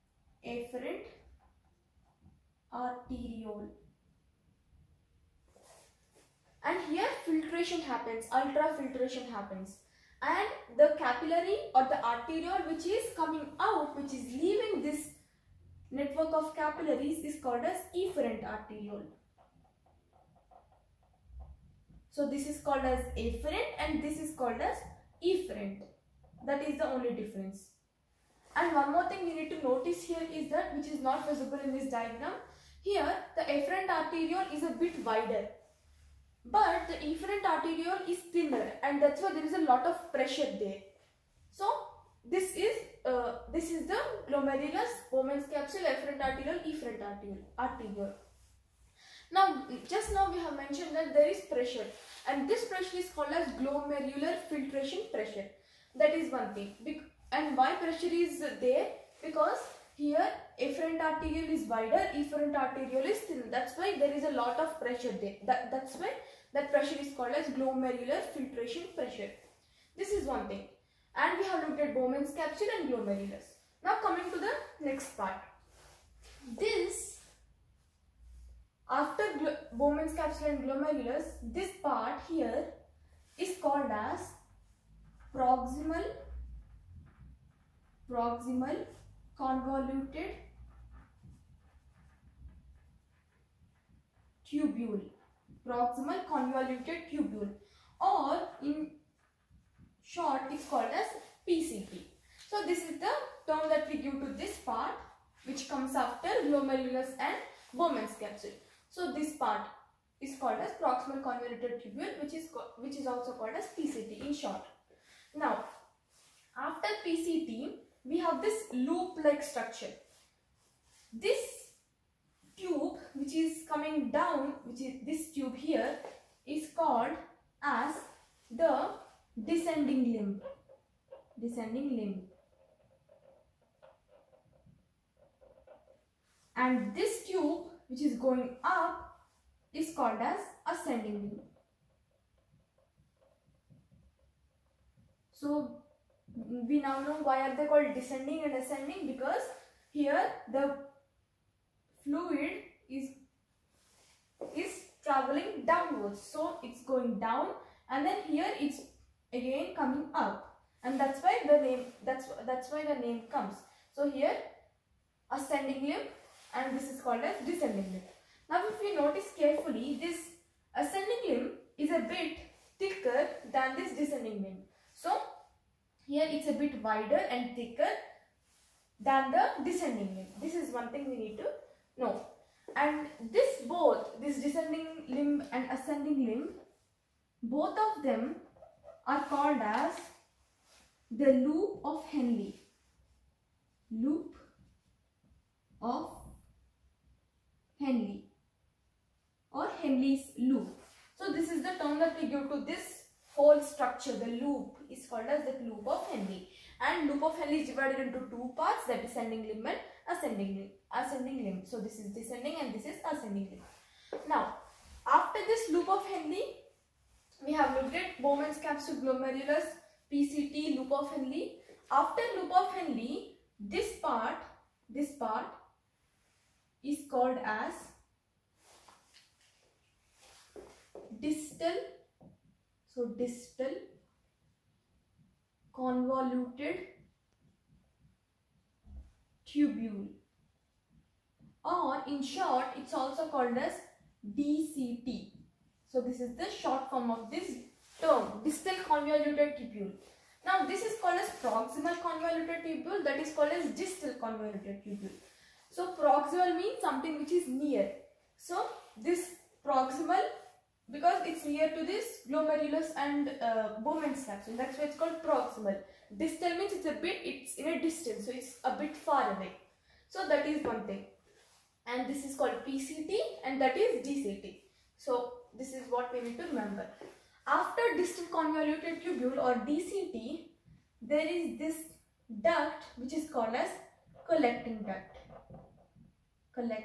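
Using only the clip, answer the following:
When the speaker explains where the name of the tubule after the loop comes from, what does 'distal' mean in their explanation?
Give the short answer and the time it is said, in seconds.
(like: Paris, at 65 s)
far away, at 268 s.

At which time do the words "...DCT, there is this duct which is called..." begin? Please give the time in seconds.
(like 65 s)
279 s.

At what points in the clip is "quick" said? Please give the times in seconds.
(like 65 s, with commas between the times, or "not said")
not said.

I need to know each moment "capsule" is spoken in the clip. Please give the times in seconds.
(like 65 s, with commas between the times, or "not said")
45 s, 72 s, 80 s, 108 s, 218 s, 264 s.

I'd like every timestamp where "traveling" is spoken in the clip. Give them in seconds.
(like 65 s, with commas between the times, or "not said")
155 s.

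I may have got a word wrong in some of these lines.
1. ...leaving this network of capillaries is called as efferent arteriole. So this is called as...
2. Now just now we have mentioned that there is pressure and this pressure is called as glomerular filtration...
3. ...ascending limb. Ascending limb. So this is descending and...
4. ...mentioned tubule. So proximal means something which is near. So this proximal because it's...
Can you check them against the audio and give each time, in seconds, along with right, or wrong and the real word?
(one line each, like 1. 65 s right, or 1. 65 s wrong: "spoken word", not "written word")
1. 14 s right
2. 49 s right
3. 210 s right
4. 254 s wrong: "convoluted", not "mentioned".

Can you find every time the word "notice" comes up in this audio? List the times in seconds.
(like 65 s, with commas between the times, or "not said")
29 s, 168 s.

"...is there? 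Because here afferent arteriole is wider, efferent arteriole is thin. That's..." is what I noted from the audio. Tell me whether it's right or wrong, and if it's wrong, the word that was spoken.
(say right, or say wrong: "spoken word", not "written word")
right.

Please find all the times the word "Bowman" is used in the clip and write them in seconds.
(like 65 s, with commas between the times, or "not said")
45 s, 71 s, 79 s, 107 s, 218 s, 263 s.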